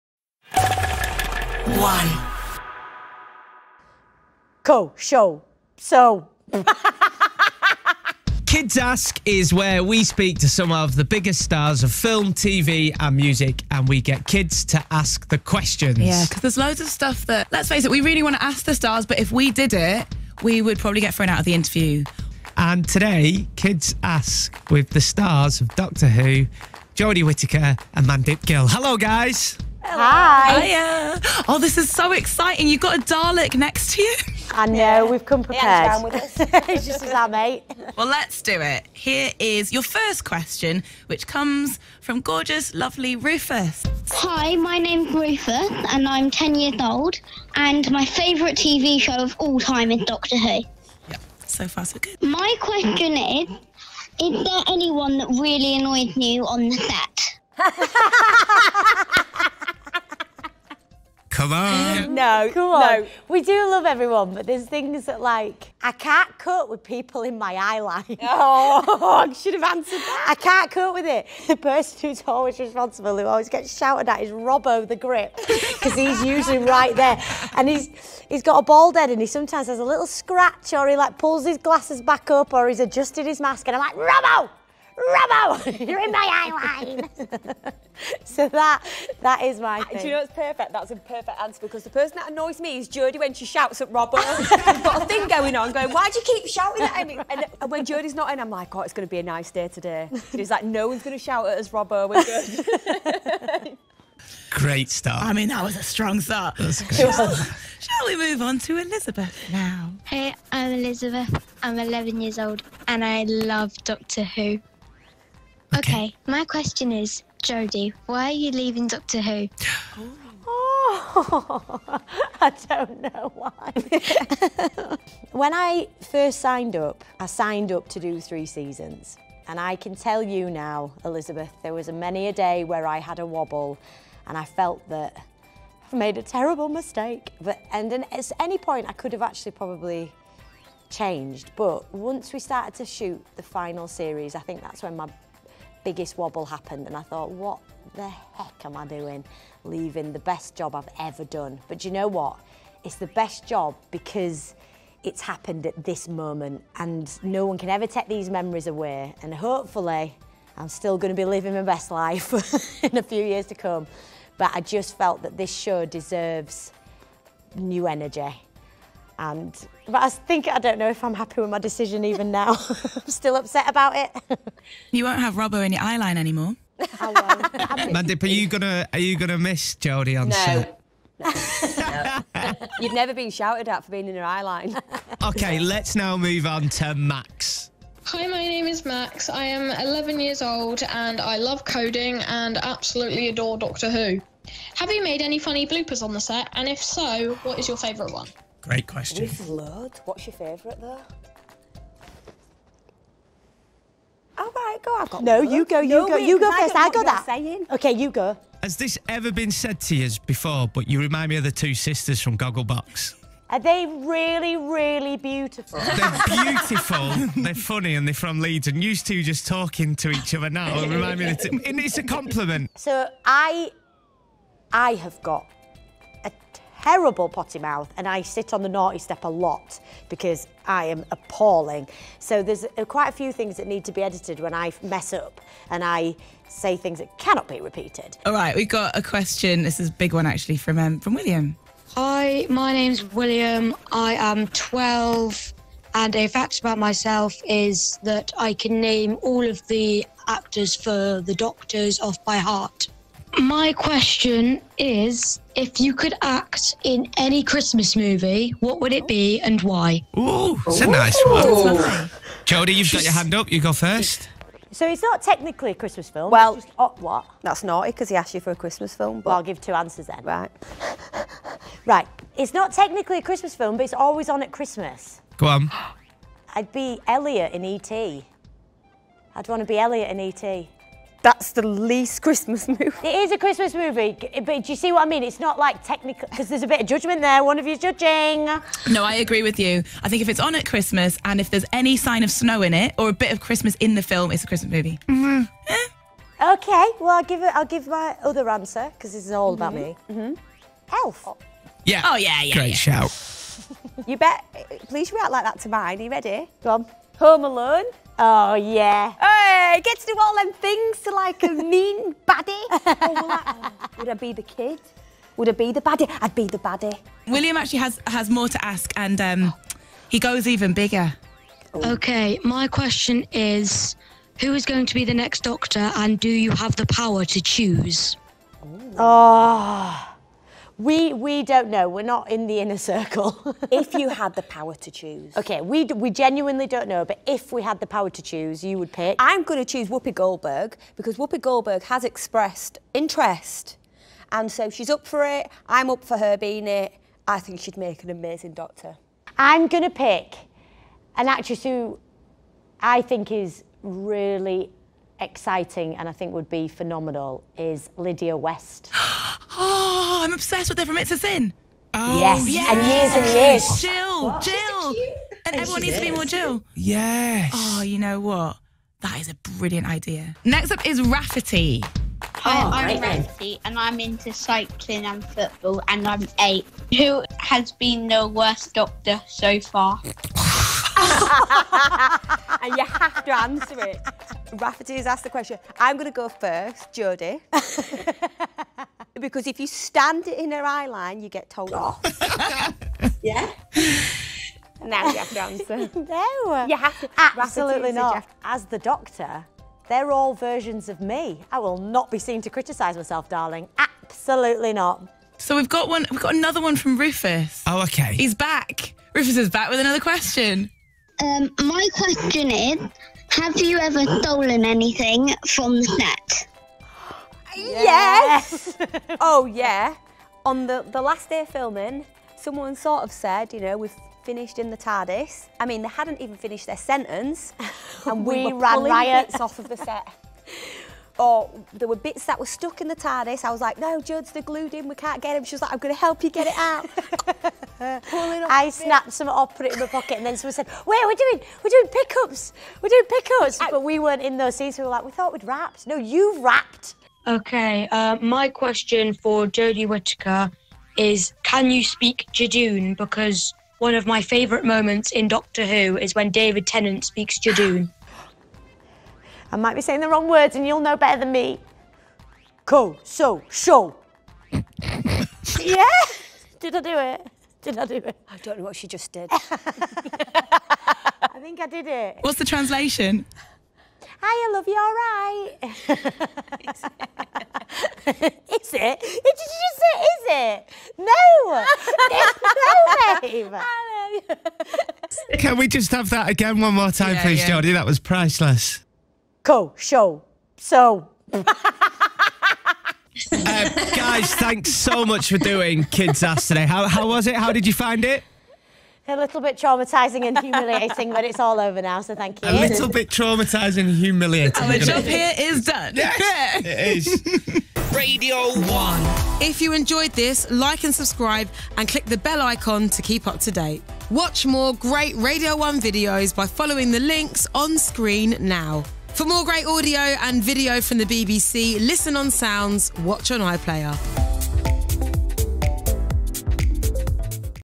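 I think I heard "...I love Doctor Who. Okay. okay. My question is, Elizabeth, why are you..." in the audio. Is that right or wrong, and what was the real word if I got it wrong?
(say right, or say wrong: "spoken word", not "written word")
wrong: "Jodie", not "Elizabeth".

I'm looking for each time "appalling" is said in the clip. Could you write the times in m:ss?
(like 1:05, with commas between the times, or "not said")
3:51.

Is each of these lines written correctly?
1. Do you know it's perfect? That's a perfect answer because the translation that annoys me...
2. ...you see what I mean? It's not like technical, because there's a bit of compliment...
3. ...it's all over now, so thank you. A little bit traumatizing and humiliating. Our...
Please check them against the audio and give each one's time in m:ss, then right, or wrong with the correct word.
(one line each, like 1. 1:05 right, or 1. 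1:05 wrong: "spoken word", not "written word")
1. 1:30 wrong: "person", not "translation"
2. 4:44 wrong: "judgment", not "compliment"
3. 8:21 right.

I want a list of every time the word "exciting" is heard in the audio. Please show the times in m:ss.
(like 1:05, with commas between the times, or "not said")
0:32, 5:55.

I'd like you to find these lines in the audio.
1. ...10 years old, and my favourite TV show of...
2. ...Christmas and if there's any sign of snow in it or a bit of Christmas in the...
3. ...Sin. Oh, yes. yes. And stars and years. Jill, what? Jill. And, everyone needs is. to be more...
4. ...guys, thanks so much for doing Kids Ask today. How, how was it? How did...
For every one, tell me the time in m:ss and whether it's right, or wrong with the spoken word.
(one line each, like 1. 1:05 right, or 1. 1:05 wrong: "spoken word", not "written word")
1. 0:46 right
2. 4:50 right
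3. 6:01 wrong: "years", not "stars"
4. 8:13 right.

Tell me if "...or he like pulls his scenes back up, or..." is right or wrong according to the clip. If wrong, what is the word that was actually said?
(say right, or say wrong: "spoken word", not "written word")
wrong: "glasses", not "scenes".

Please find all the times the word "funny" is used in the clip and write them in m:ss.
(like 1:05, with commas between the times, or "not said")
3:15, 3:37.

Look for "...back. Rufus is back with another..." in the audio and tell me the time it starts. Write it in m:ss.
6:48.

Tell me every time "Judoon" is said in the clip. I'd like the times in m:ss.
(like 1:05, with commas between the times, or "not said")
7:32, 7:37.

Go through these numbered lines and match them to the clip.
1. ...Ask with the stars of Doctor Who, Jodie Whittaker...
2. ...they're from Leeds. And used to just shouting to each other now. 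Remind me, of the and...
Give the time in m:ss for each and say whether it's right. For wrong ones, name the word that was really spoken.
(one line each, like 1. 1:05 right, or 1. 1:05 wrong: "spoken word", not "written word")
1. 0:24 right
2. 3:38 wrong: "talking", not "shouting".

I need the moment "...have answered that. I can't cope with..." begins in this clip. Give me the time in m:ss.
1:09.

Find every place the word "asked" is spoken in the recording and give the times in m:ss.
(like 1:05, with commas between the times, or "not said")
4:28, 6:25.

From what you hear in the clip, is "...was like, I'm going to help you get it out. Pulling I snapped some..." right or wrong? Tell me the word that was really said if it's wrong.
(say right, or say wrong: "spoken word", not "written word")
right.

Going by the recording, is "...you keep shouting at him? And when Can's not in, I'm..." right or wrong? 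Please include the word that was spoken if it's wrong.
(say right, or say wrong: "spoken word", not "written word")
wrong: "Jodie", not "Can".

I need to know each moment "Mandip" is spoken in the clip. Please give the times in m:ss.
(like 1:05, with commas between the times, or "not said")
0:28, 2:56.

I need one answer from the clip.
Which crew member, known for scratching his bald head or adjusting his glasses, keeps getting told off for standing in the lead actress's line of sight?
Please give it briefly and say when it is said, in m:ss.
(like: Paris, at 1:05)
Robbo the Grip, at 1:14.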